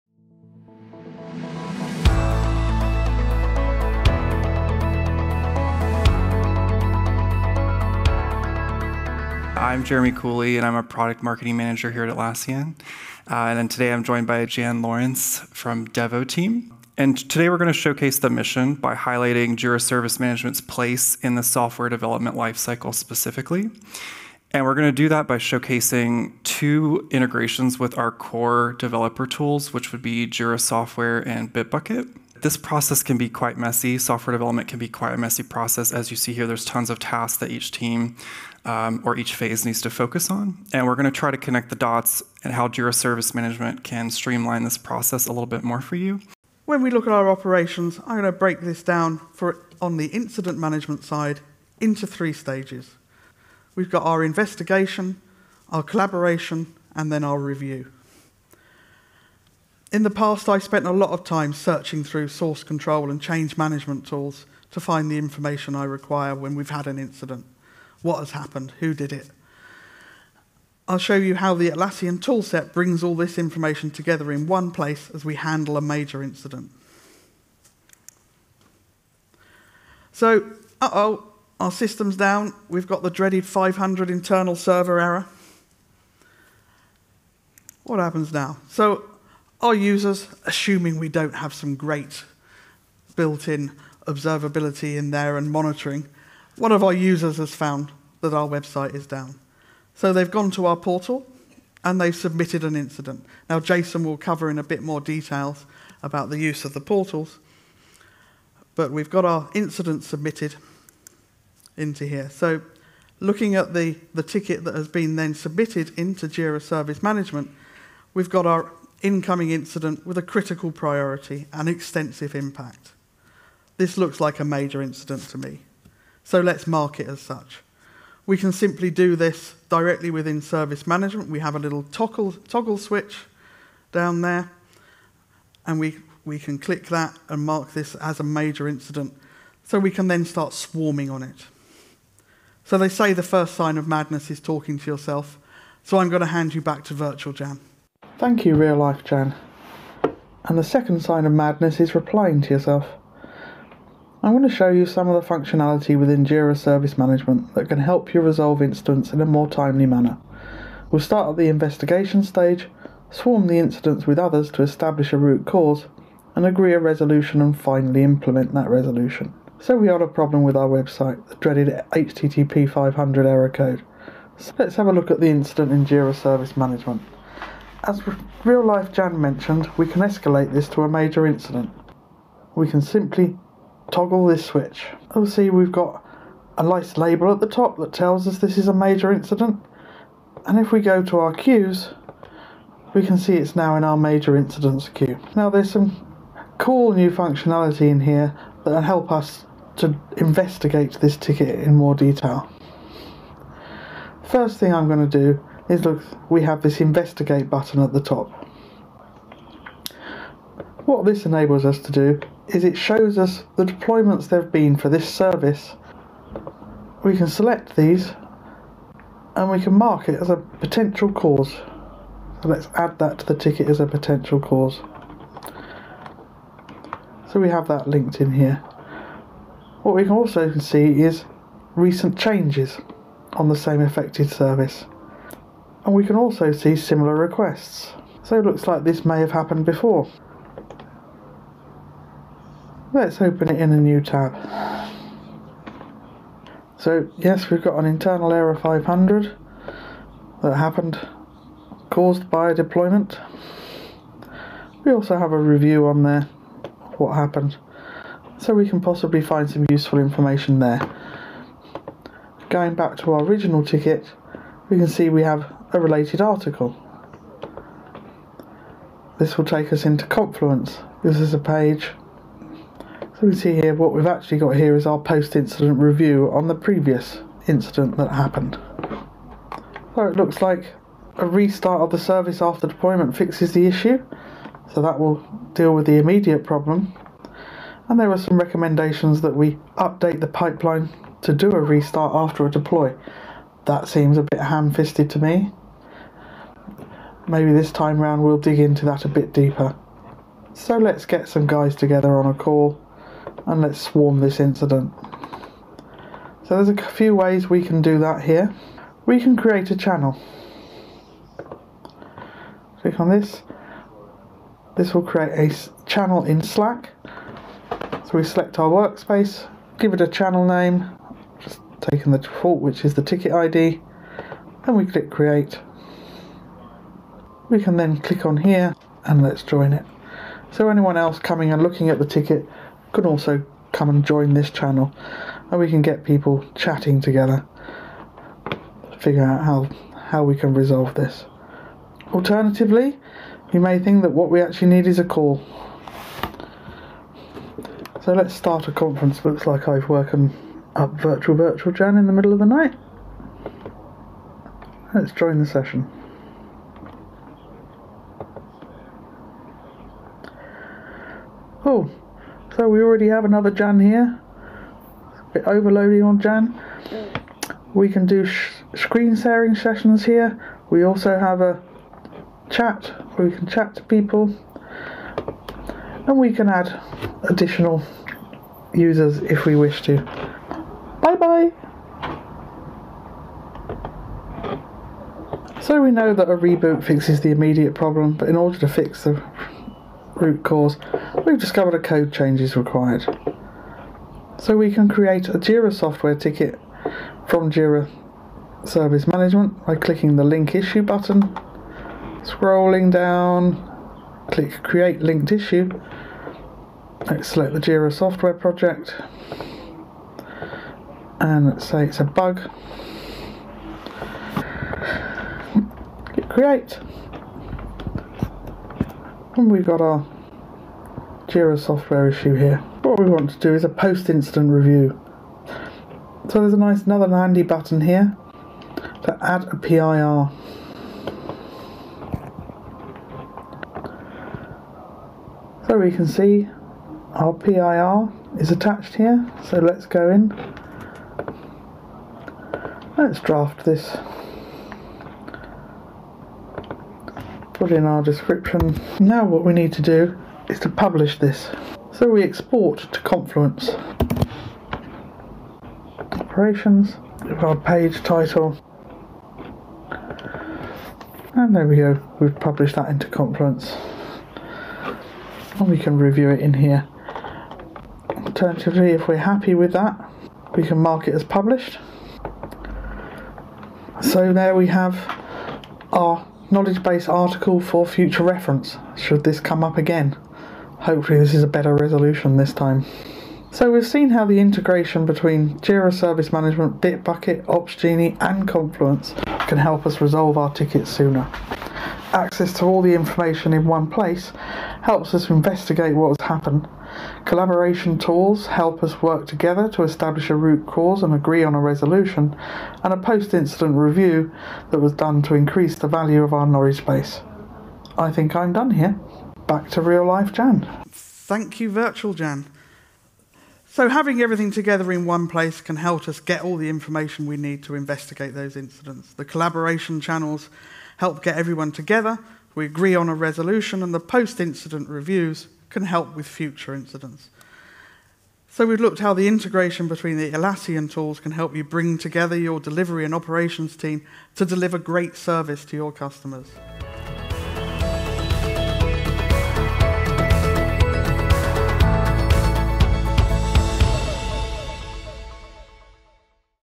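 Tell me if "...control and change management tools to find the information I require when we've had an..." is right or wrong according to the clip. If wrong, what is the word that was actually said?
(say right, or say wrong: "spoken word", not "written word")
right.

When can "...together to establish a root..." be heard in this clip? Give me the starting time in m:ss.
8:19.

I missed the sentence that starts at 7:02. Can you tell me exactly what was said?
What we want to do is a post-incident review.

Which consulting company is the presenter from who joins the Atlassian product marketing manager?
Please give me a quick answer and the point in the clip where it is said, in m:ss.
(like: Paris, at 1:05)
Devoteam, at 0:15.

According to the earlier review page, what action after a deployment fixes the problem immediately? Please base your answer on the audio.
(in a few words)
A restart of the service.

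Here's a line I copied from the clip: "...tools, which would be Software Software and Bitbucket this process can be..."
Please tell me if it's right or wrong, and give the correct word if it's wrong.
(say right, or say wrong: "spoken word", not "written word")
wrong: "Jira", not "Software".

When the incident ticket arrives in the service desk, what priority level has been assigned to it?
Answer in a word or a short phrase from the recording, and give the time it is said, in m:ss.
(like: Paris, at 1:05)
Critical, at 2:00.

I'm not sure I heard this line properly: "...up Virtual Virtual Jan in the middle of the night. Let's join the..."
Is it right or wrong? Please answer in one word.
right.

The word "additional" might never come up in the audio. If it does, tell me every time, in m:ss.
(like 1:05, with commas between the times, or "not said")
6:17.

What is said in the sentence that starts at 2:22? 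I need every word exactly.
So they say the first sign of madness is talking to yourself, so I'm going to hand you back to Virtual Jan.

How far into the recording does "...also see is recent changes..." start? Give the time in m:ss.
3:50.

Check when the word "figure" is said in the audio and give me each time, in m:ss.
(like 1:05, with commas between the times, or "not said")
5:38.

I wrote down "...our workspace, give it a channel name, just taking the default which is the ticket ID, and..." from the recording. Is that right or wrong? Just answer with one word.
right.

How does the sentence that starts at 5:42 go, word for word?
Alternatively, you may think that what we actually need is a call.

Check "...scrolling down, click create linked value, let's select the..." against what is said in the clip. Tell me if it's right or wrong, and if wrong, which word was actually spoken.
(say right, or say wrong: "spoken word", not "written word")
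wrong: "issue", not "value".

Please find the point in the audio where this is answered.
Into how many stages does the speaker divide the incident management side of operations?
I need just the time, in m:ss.
0:52.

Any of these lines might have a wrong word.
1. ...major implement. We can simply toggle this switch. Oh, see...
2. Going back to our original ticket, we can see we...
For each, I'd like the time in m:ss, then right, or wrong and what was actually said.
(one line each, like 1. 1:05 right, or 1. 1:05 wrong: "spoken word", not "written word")
1. 3:00 wrong: "incident", not "implement"
2. 4:22 right.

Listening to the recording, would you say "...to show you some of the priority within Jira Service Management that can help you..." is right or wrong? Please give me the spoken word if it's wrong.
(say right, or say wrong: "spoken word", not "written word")
wrong: "functionality", not "priority".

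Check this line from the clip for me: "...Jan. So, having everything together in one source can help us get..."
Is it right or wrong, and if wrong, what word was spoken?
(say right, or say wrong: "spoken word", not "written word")
wrong: "place", not "source".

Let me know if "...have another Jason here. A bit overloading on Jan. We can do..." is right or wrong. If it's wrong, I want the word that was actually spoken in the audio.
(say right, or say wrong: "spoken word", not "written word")
wrong: "Jan", not "Jason".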